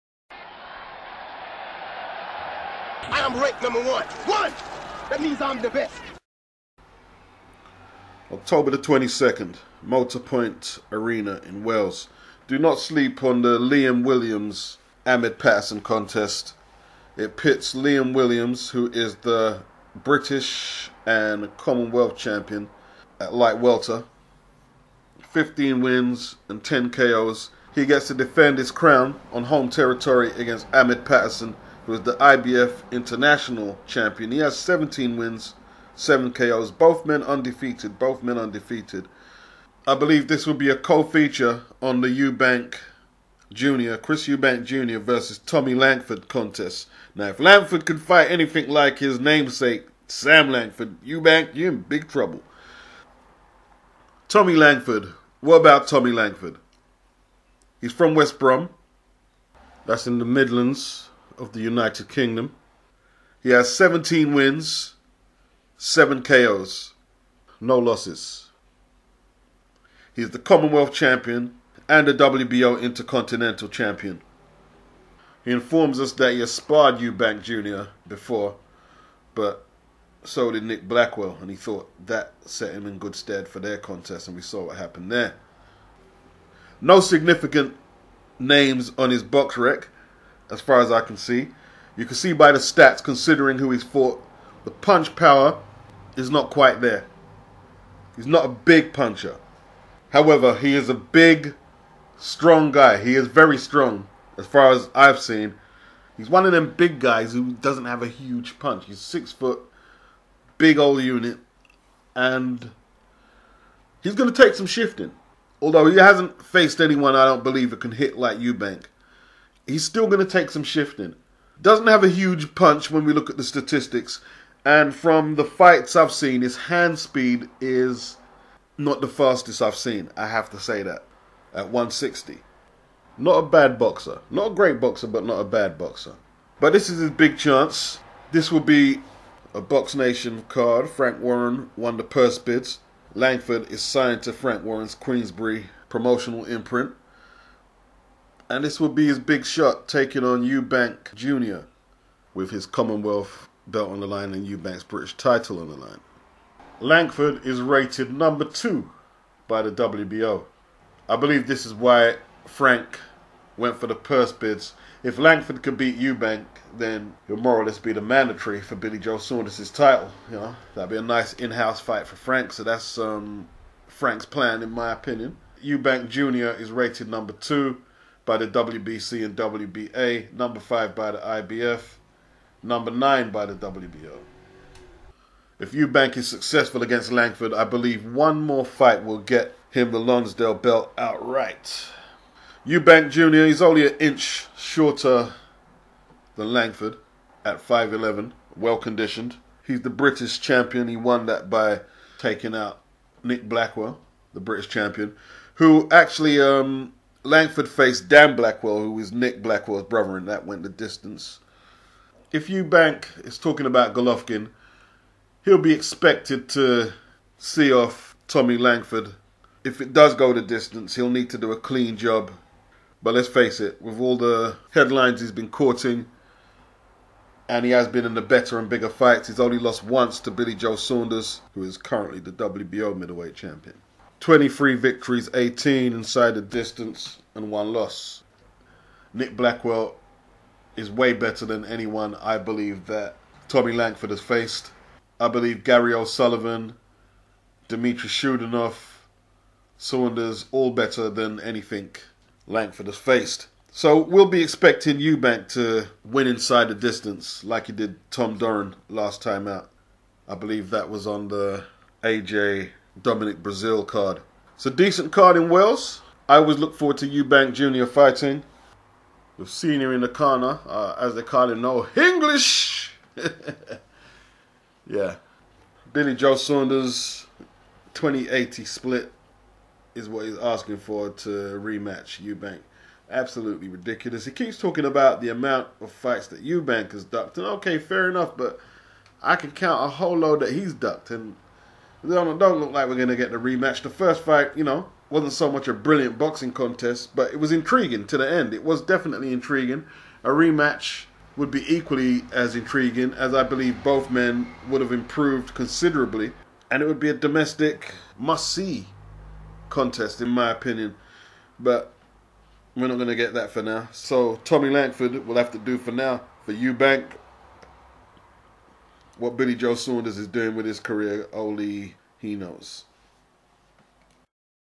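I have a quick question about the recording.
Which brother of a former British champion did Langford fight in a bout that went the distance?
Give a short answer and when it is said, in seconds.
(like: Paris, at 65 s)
Dan Blackwell, at 208 s.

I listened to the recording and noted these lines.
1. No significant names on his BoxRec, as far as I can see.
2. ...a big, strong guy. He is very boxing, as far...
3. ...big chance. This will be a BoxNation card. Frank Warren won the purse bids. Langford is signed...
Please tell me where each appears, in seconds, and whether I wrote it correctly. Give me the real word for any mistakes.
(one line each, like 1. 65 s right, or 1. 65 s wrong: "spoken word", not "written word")
1. 86 s right
2. 100 s wrong: "strong", not "boxing"
3. 137 s right.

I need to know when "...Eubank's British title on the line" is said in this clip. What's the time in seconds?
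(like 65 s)
154 s.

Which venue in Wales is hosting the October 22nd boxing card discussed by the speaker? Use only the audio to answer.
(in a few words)
Motorpoint Arena.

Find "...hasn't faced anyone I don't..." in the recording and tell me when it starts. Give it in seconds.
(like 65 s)
115 s.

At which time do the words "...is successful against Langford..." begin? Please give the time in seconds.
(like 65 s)
186 s.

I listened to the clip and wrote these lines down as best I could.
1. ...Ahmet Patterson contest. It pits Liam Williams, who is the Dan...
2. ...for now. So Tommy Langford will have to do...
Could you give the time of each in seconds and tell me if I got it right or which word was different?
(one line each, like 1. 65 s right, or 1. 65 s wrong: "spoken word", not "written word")
1. 15 s wrong: "British", not "Dan"
2. 313 s right.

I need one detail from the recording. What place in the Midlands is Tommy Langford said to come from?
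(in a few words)
West Brom.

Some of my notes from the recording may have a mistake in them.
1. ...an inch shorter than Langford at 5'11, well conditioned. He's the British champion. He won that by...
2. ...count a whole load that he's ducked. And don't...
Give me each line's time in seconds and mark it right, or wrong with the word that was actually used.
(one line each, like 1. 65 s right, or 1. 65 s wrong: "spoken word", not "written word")
1. 193 s right
2. 289 s right.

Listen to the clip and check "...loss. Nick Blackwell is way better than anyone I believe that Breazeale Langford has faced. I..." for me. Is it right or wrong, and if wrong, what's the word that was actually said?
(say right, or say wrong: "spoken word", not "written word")
wrong: "Tommy", not "Breazeale".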